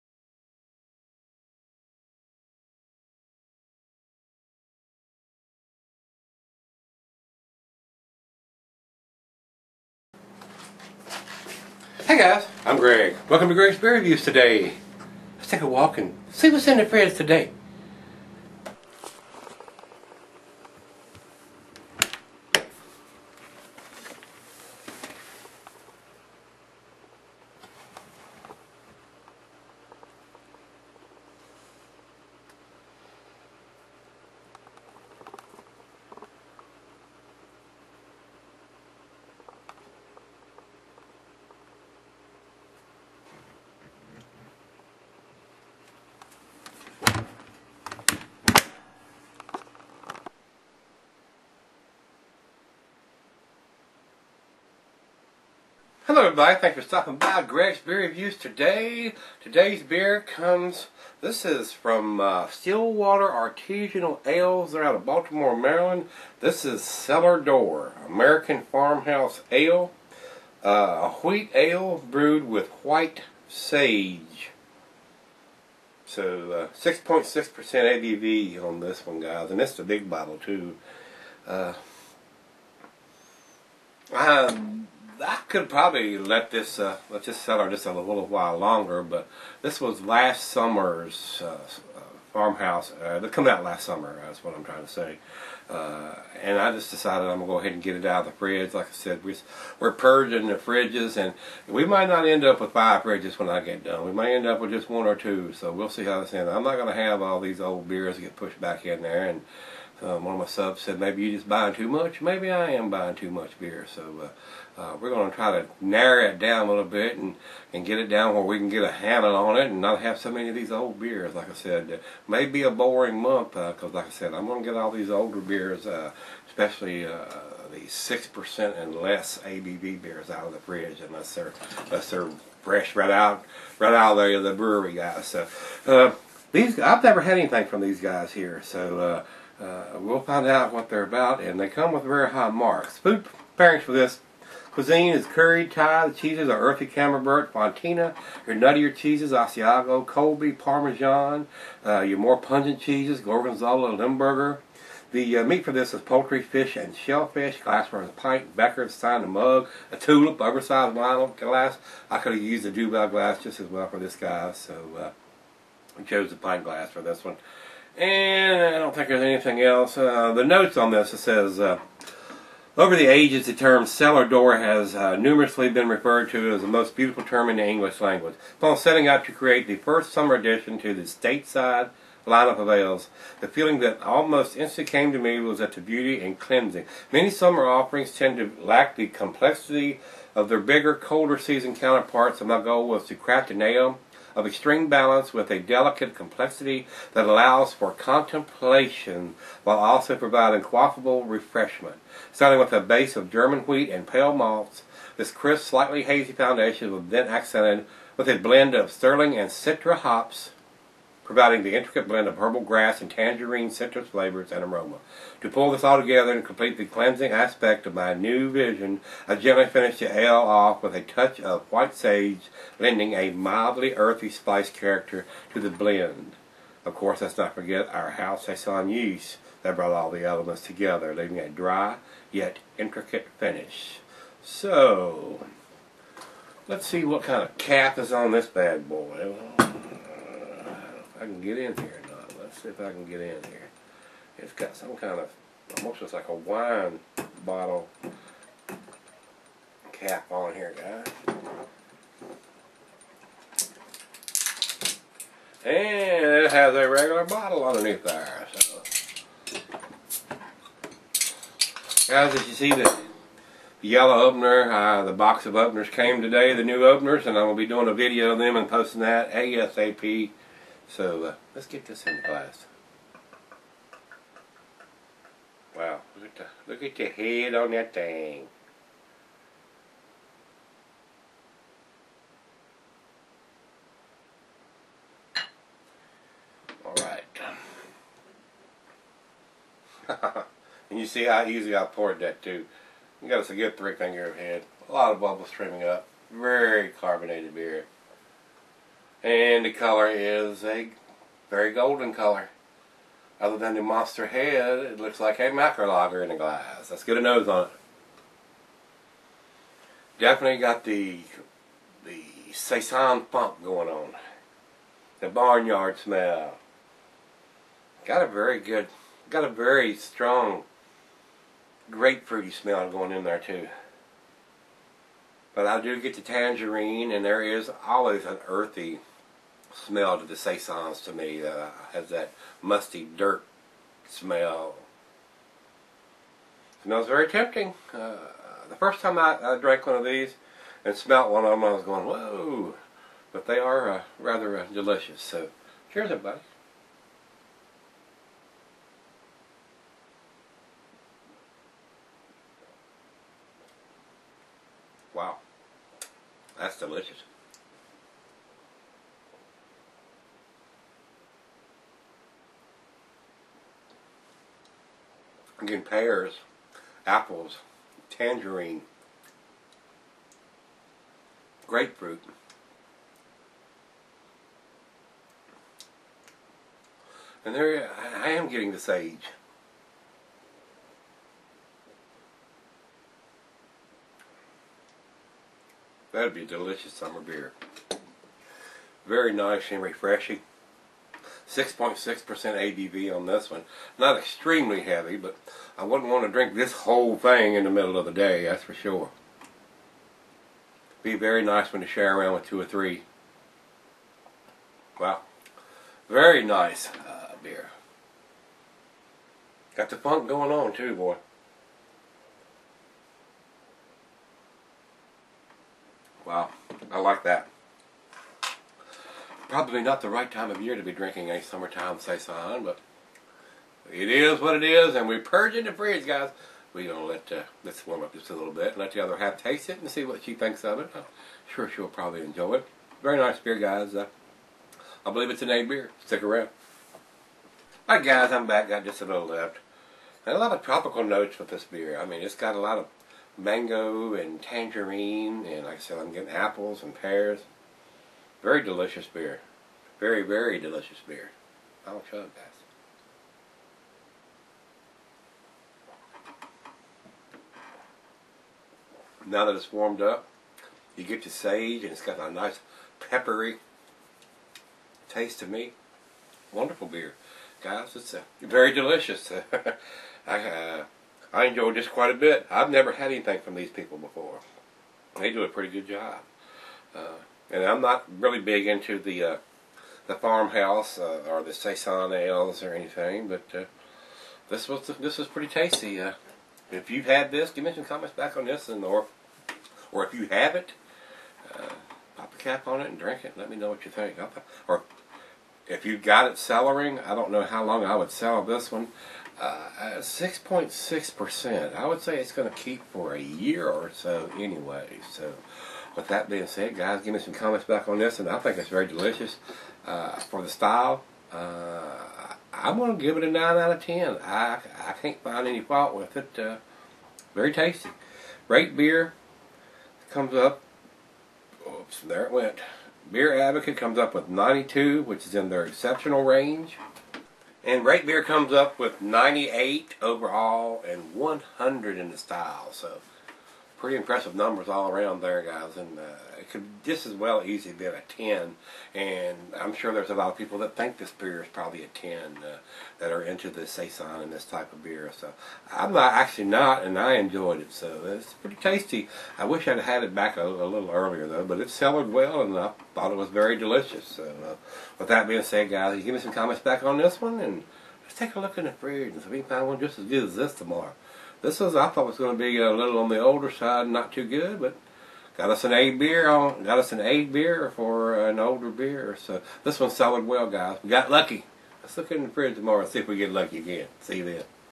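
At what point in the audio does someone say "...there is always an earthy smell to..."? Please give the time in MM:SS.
05:27.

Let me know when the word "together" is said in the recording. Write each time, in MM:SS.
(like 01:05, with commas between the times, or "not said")
03:36, 03:50.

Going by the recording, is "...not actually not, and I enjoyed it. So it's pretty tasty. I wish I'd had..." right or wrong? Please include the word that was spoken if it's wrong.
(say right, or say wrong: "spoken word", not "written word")
right.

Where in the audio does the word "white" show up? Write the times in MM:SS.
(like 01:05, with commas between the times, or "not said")
01:12, 03:41.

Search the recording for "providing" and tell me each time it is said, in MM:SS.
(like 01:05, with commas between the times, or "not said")
03:20, 03:31.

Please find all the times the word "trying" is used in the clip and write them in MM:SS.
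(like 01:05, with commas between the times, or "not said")
01:34.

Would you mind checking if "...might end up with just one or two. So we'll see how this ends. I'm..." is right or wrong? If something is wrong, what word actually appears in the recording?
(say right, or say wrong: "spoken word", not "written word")
right.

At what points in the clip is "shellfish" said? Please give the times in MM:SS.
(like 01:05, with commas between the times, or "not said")
02:36.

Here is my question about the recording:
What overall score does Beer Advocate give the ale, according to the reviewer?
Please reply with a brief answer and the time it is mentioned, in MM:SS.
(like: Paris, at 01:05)
92, at 08:44.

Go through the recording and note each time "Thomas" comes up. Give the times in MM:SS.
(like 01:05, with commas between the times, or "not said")
not said.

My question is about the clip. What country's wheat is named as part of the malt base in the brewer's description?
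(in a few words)
German.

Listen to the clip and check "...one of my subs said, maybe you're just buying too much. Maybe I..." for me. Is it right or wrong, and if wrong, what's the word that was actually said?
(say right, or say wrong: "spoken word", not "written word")
right.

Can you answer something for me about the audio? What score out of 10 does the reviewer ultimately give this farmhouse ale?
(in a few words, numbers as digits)
9.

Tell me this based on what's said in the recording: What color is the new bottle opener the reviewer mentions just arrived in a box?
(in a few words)
yellow.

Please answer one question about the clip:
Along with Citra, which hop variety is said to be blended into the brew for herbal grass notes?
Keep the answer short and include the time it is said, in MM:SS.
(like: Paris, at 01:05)
Sterling, at 03:28.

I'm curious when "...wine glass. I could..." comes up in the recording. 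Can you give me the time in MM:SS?
02:40.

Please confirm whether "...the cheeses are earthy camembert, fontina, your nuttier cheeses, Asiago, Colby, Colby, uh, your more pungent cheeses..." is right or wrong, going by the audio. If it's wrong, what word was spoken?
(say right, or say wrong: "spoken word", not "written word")
wrong: "Parmesan", not "Colby".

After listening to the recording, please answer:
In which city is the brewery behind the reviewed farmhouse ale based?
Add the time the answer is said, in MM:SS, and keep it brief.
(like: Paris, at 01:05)
Baltimore, Maryland, at 01:05.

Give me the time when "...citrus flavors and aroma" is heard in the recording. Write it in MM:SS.
03:33.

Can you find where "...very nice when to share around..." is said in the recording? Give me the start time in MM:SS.
06:41.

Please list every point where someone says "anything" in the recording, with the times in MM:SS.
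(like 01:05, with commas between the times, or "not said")
02:17, 02:49, 07:53, 08:02.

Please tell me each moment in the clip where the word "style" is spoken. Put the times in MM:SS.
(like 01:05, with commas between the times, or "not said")
08:30, 08:52.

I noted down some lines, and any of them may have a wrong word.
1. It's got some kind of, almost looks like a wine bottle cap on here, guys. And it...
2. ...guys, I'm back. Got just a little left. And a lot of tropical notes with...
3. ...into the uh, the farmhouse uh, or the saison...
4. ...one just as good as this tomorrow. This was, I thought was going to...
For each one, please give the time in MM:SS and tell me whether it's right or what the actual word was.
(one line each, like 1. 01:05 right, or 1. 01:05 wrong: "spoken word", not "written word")
1. 04:04 right
2. 07:18 right
3. 07:58 right
4. 09:19 right.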